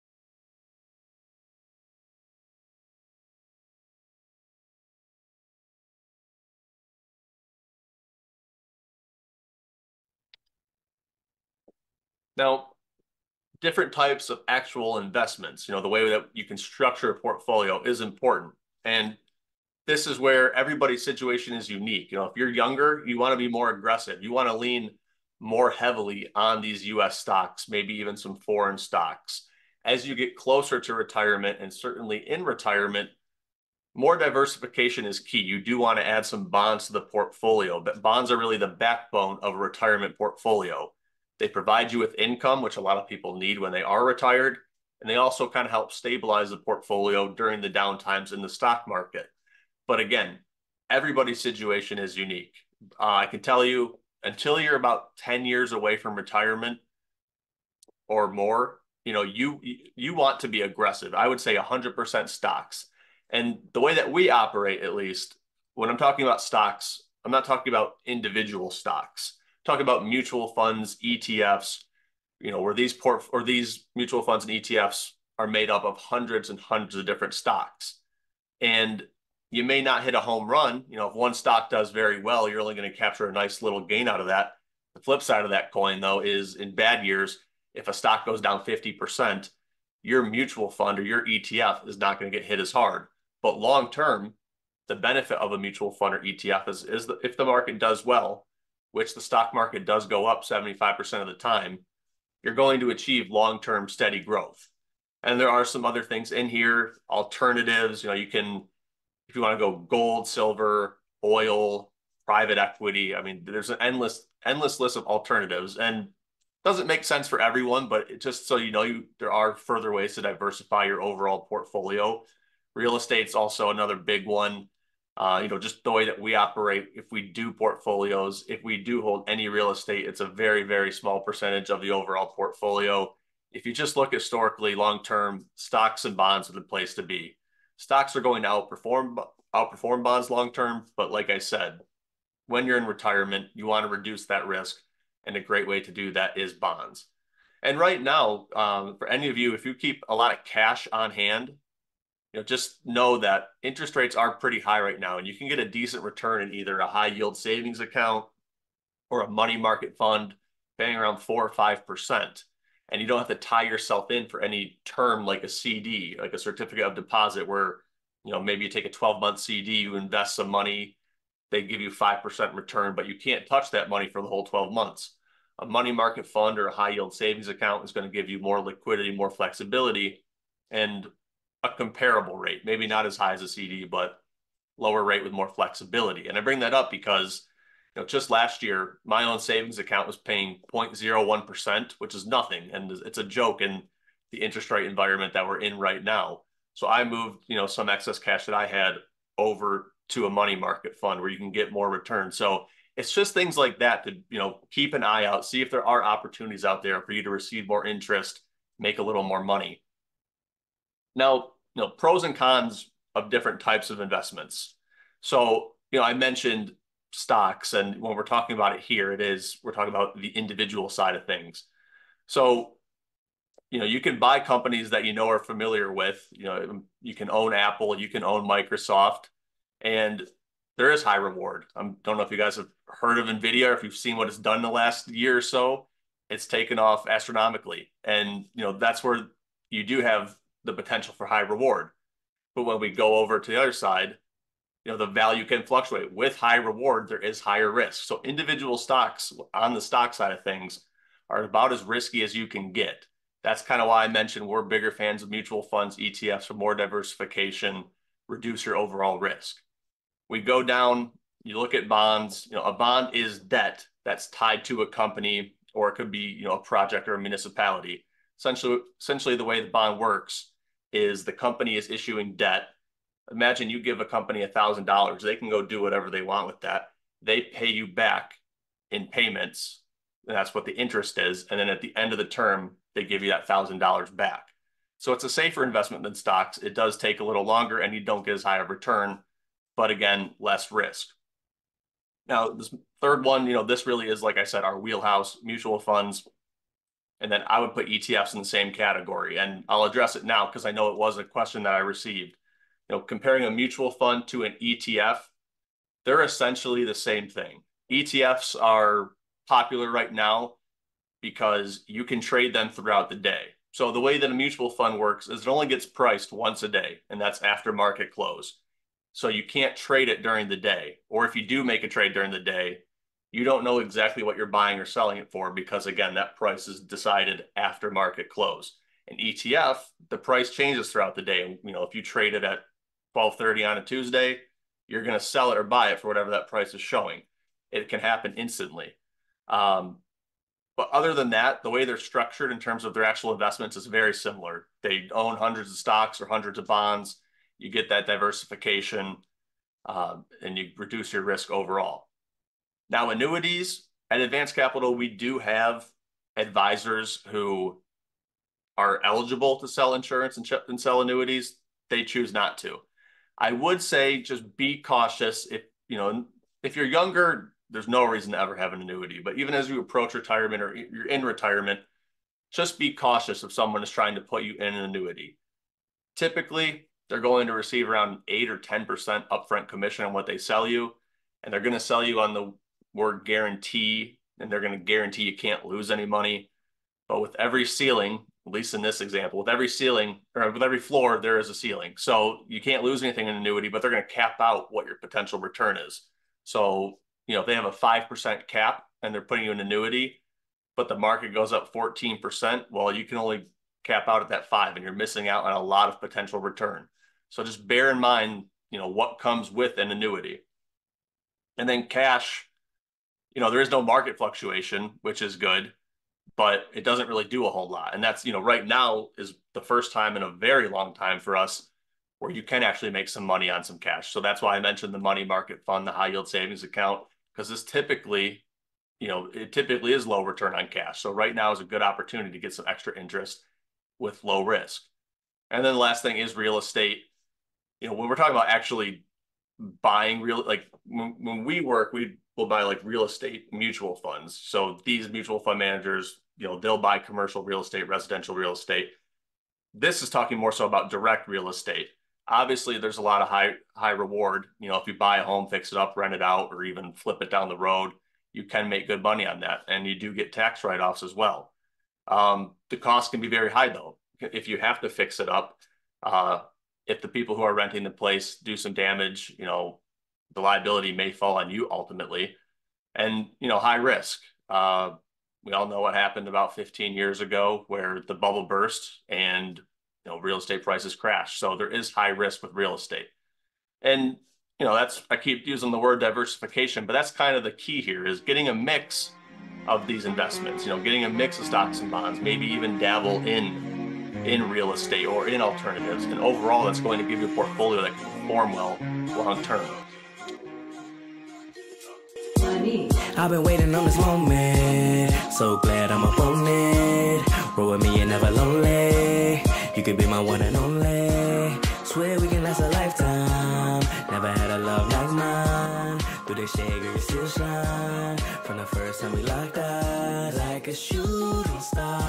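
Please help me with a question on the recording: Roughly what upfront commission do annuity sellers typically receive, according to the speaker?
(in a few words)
8 or 10%.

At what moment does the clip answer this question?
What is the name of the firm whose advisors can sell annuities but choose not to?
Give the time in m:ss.
5:54.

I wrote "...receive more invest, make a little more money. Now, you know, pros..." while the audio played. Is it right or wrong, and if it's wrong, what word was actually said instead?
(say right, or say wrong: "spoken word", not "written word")
wrong: "interest", not "invest".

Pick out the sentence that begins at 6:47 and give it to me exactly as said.
So just bear in mind, you know, what comes with an annuity.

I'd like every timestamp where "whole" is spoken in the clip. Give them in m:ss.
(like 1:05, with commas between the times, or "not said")
2:54, 6:57.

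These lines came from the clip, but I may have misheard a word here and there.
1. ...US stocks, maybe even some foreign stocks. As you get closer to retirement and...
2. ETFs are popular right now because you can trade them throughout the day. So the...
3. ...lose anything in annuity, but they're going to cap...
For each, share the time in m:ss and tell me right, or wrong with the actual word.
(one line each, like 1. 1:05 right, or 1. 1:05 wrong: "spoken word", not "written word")
1. 0:26 right
2. 5:07 right
3. 6:32 right.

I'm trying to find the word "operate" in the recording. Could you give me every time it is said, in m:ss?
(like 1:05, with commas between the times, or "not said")
1:04, 2:06.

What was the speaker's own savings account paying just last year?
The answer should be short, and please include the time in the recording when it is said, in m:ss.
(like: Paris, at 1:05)
0.01%, at 3:10.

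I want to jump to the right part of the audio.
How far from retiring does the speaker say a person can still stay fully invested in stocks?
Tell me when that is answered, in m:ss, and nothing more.
0:55.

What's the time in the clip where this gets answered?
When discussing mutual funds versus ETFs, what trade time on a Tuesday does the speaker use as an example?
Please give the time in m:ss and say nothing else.
5:33.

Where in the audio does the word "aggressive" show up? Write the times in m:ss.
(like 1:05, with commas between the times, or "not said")
0:23, 1:00.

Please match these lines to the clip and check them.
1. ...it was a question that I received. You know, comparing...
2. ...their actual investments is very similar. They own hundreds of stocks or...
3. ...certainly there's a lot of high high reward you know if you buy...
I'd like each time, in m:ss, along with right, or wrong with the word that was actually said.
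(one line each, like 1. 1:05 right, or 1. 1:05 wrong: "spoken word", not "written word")
1. 5:00 right
2. 5:42 right
3. 7:32 wrong: "obviously", not "certainly".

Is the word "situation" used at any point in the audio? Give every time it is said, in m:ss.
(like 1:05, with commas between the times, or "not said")
0:21, 0:51.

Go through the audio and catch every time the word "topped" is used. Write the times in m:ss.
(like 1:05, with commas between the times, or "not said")
not said.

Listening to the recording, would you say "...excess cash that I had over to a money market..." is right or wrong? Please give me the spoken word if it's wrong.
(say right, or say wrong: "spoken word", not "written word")
right.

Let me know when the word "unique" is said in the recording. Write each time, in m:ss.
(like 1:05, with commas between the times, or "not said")
0:21, 0:52.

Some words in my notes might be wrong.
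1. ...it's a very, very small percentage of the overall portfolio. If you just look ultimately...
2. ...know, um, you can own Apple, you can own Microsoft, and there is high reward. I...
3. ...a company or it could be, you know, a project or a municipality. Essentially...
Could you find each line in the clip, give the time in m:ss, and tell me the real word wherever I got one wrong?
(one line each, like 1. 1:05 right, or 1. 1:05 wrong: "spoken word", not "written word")
1. 2:10 wrong: "historically", not "ultimately"
2. 3:46 right
3. 4:24 right.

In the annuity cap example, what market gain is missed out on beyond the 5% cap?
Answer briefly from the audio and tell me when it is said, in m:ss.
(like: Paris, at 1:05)
14%, at 6:41.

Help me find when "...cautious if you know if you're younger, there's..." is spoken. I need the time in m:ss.
6:04.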